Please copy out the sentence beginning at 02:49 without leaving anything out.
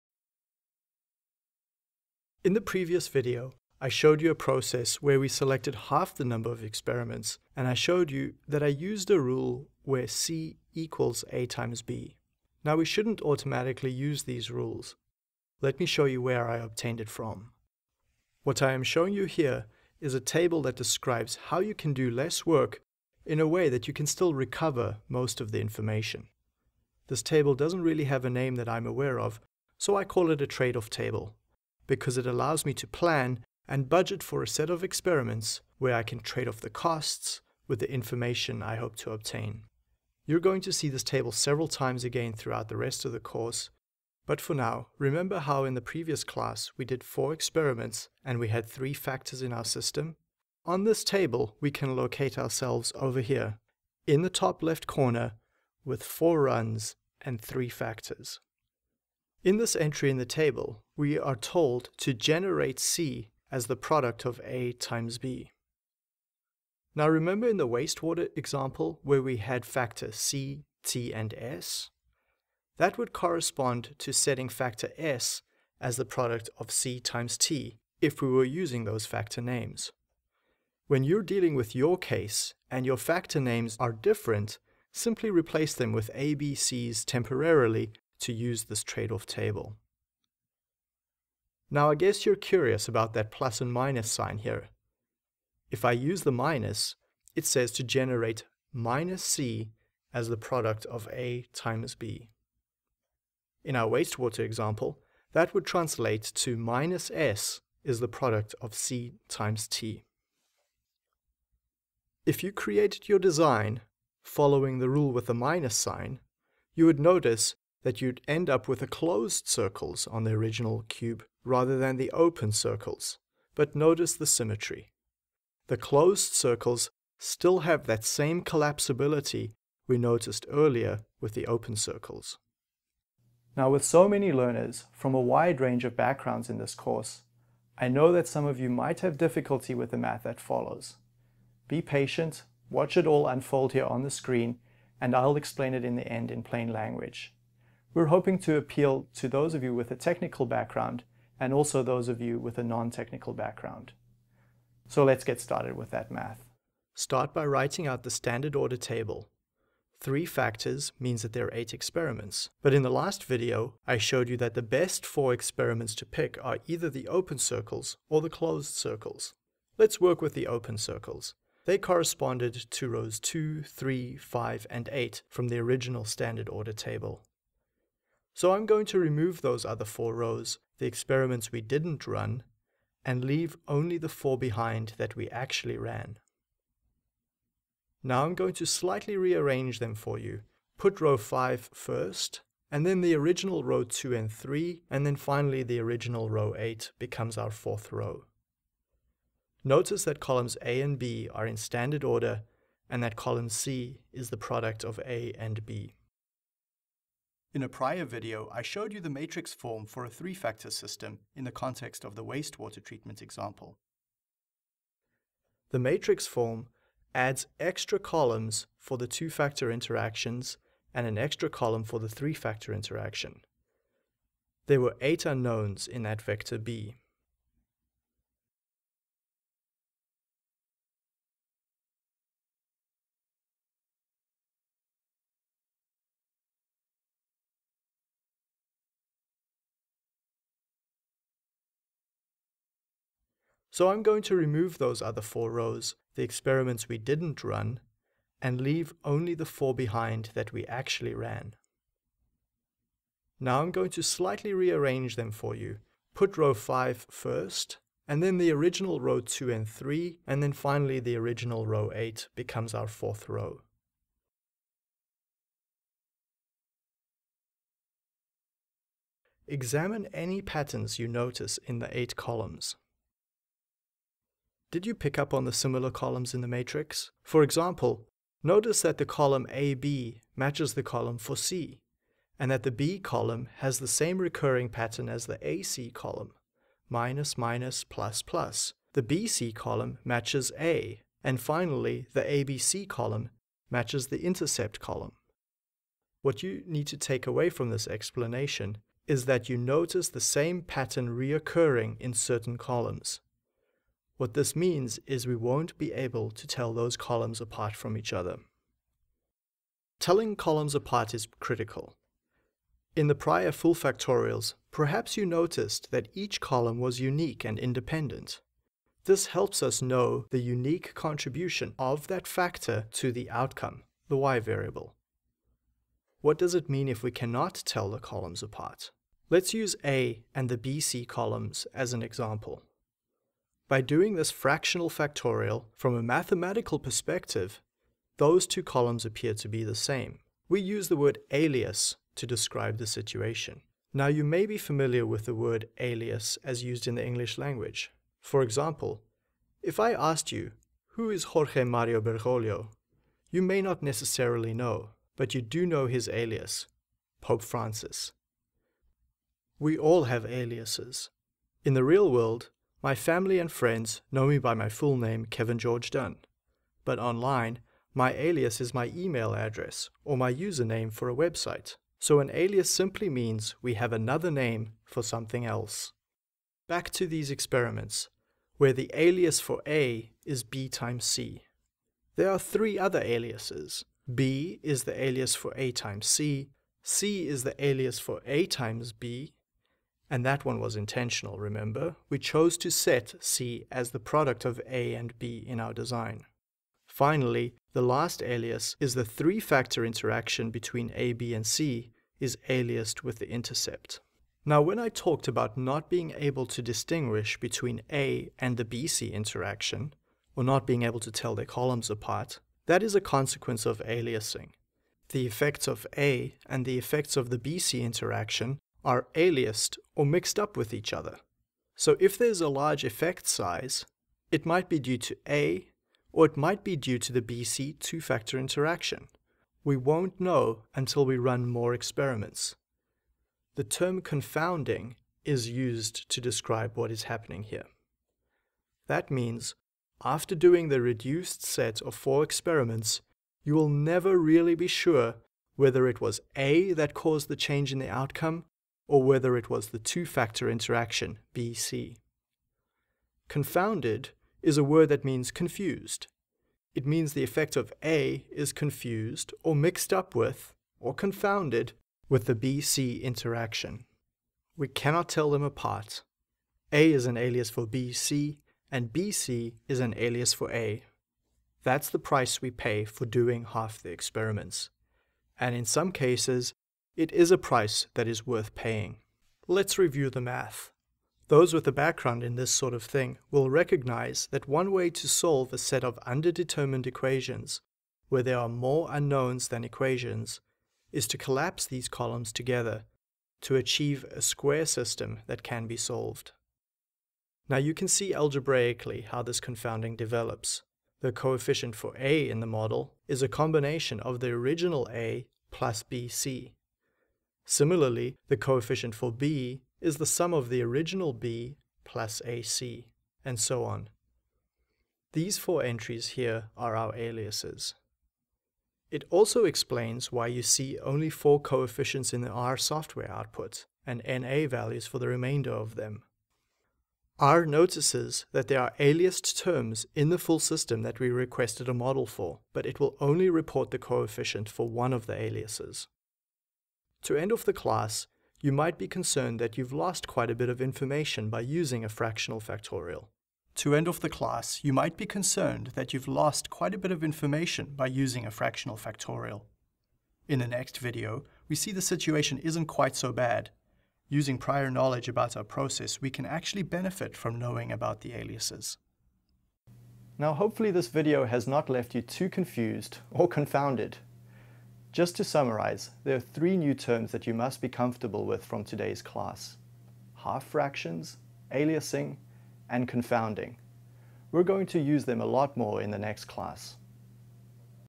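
Let's work with the open circles.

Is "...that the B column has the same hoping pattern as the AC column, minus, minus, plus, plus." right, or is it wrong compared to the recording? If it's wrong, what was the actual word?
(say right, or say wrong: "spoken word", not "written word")
wrong: "recurring", not "hoping".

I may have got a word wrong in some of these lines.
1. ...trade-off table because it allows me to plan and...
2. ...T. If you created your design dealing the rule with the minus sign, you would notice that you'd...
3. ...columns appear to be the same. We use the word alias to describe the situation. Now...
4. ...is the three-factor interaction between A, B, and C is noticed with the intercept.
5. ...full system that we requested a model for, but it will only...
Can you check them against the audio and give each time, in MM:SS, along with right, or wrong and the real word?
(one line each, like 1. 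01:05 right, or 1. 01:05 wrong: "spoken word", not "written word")
1. 00:30 right
2. 01:49 wrong: "following", not "dealing"
3. 05:38 right
4. 06:38 wrong: "aliased", not "noticed"
5. 08:50 right.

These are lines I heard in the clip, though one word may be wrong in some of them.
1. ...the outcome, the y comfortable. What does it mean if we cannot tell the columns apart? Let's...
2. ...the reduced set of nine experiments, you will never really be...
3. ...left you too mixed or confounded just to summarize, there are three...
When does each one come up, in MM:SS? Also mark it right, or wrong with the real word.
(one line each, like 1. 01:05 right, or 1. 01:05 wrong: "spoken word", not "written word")
1. 05:23 wrong: "variable", not "comfortable"
2. 07:20 wrong: "four", not "nine"
3. 09:21 wrong: "confused", not "mixed".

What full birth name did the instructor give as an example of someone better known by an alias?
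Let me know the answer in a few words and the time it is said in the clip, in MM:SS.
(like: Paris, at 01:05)
Jorge Mario Bergoglio, at 05:51.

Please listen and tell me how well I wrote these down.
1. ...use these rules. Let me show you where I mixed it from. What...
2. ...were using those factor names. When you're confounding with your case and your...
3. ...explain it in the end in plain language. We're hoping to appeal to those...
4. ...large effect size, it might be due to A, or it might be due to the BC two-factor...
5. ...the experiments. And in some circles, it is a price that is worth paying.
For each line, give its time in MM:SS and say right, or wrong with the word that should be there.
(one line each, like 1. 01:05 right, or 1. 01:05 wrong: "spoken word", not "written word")
1. 00:13 wrong: "obtained", not "mixed"
2. 01:18 wrong: "dealing", not "confounding"
3. 02:25 right
4. 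07:02 right
5. 07:53 wrong: "cases", not "circles".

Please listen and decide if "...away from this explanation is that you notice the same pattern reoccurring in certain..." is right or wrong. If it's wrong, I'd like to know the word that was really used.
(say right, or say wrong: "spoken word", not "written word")
right.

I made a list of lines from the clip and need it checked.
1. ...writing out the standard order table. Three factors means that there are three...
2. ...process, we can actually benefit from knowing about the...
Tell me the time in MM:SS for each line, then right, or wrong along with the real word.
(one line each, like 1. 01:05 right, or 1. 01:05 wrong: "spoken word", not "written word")
1. 02:37 wrong: "eight", not "three"
2. 09:15 right.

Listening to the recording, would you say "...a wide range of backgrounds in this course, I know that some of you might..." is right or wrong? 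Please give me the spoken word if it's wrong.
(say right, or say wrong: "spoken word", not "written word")
right.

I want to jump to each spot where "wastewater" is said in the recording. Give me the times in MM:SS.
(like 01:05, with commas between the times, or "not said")
01:07, 01:43, 03:32.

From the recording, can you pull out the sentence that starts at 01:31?
Now I guess you're curious about that plus and minus sign here.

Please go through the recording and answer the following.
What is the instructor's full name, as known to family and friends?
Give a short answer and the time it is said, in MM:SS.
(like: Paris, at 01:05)
Kevin George Dunn, at 06:05.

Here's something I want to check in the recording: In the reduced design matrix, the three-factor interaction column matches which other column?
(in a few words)
intercept column.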